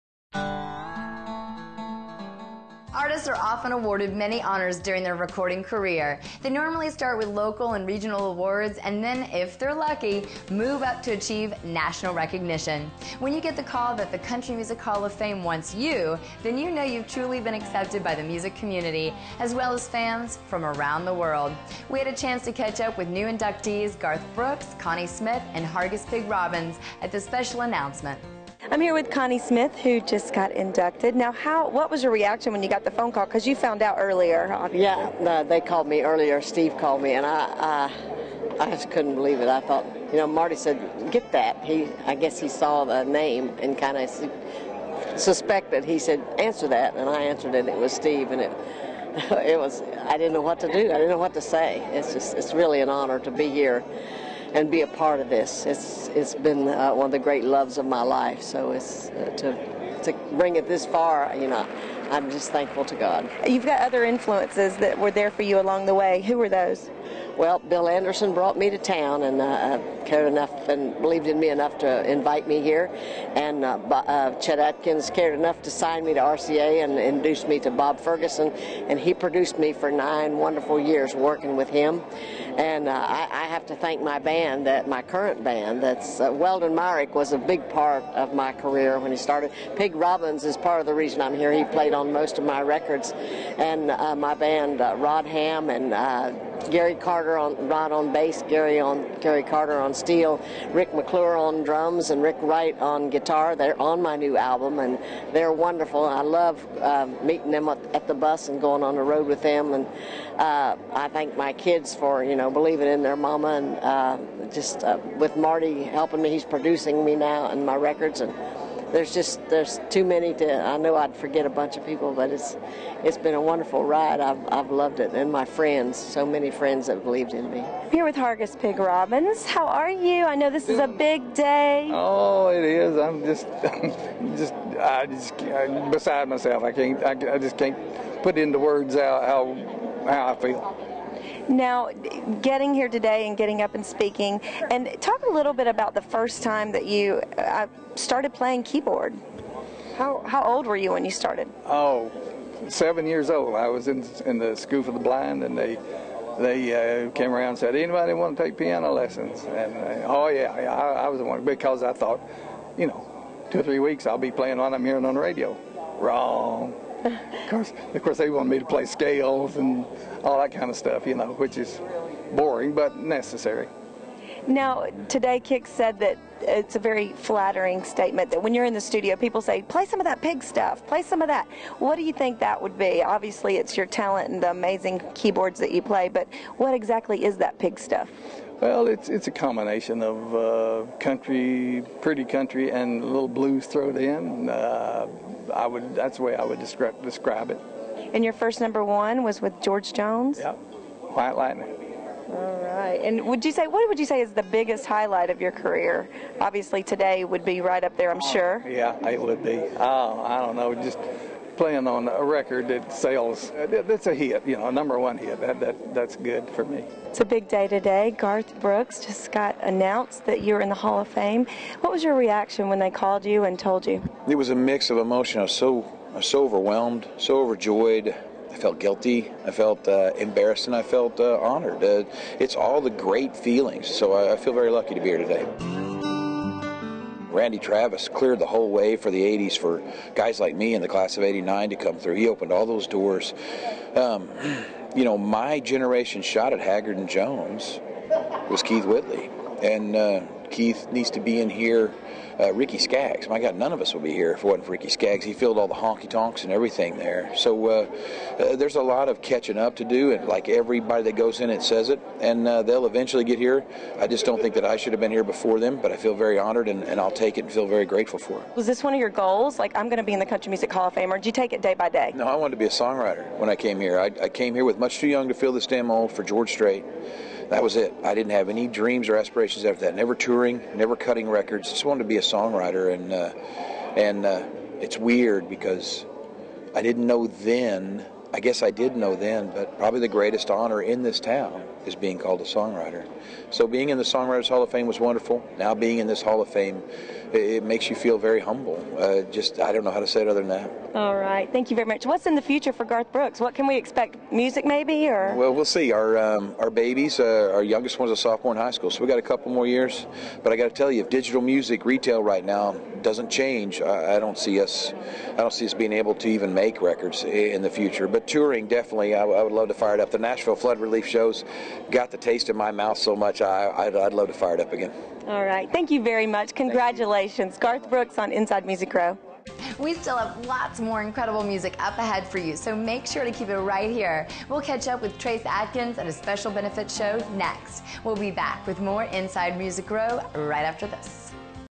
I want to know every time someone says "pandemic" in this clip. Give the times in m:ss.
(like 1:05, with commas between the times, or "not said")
not said.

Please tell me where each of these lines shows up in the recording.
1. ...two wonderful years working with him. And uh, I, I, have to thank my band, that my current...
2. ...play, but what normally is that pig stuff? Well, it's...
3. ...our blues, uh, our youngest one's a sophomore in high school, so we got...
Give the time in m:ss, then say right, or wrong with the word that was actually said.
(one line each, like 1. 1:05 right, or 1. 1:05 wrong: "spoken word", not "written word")
1. 1:19 wrong: "nine", not "two"
2. 3:05 wrong: "exactly", not "normally"
3. 5:06 wrong: "babies", not "blues".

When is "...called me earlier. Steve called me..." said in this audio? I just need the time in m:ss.
0:35.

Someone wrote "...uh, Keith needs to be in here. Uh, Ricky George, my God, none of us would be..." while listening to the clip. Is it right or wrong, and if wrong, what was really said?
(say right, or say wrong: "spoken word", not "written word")
wrong: "Skaggs", not "George".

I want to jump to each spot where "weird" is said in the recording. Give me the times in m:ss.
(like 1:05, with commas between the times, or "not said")
4:44.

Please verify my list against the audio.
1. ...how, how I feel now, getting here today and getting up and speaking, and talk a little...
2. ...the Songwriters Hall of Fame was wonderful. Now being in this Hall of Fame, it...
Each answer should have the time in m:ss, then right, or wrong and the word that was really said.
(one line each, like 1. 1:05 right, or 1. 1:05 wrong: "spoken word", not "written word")
1. 2:20 right
2. 4:53 right.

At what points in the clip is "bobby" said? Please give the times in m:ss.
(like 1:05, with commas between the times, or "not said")
not said.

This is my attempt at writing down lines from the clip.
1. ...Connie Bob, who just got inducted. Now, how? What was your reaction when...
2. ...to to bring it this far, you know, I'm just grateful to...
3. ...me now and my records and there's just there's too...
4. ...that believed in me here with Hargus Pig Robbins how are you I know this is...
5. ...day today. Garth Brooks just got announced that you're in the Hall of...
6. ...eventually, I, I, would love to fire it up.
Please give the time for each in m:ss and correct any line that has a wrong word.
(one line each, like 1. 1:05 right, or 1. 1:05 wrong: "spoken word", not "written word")
1. 0:29 wrong: "Smith", not "Bob"
2. 0:59 wrong: "thankful", not "grateful"
3. 1:57 right
4. 2:06 right
5. 3:37 right
6. 5:18 wrong: "definitely", not "eventually".